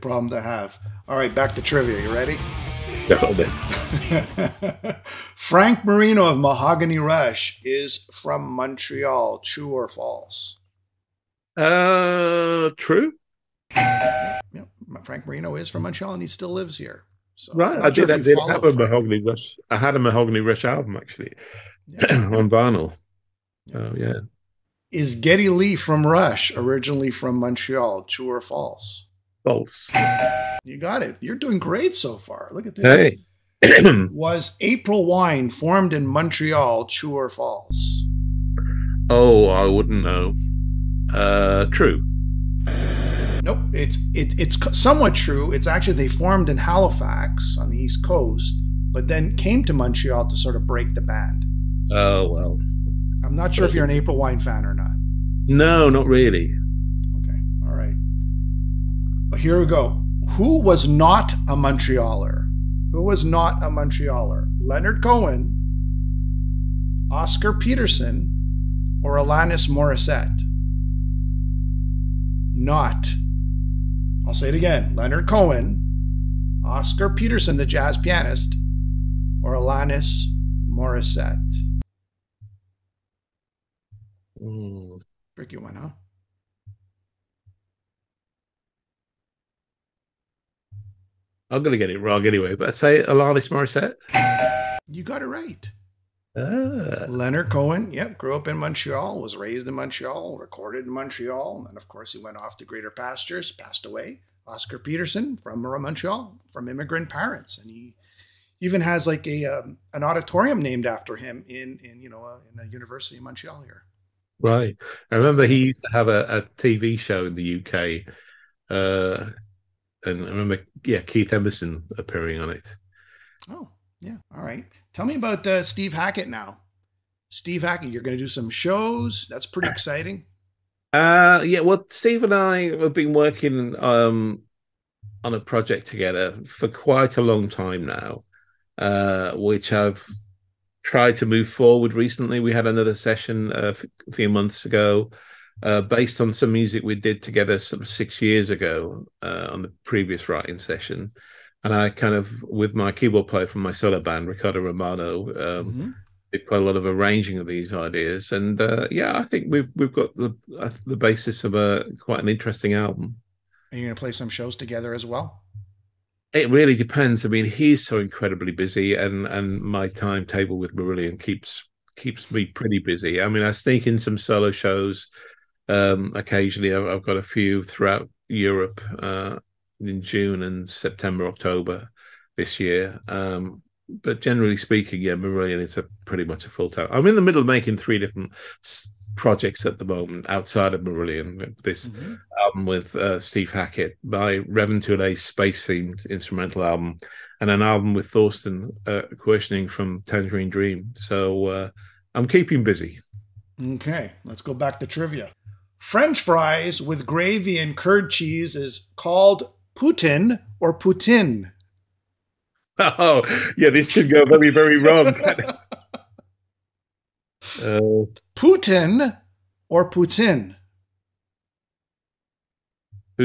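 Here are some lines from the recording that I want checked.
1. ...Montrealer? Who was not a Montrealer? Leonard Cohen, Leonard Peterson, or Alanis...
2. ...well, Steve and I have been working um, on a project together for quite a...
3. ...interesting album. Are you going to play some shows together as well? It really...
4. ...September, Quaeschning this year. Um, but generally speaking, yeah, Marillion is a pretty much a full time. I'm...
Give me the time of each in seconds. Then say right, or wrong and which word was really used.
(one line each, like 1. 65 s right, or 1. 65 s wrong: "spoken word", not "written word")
1. 61 s wrong: "Oscar", not "Leonard"
2. 131 s right
3. 162 s right
4. 180 s wrong: "October", not "Quaeschning".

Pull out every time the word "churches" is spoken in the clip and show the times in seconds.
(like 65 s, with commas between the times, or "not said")
not said.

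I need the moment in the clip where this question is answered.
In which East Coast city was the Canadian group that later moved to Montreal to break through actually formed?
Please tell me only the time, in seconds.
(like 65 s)
46 s.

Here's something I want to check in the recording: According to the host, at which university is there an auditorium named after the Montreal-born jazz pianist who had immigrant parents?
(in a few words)
University of Montreal.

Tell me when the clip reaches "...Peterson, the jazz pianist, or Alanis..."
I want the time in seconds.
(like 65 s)
77 s.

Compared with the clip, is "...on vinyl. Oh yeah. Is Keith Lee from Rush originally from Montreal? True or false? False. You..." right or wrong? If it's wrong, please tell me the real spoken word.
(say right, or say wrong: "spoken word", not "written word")
wrong: "Getty", not "Keith".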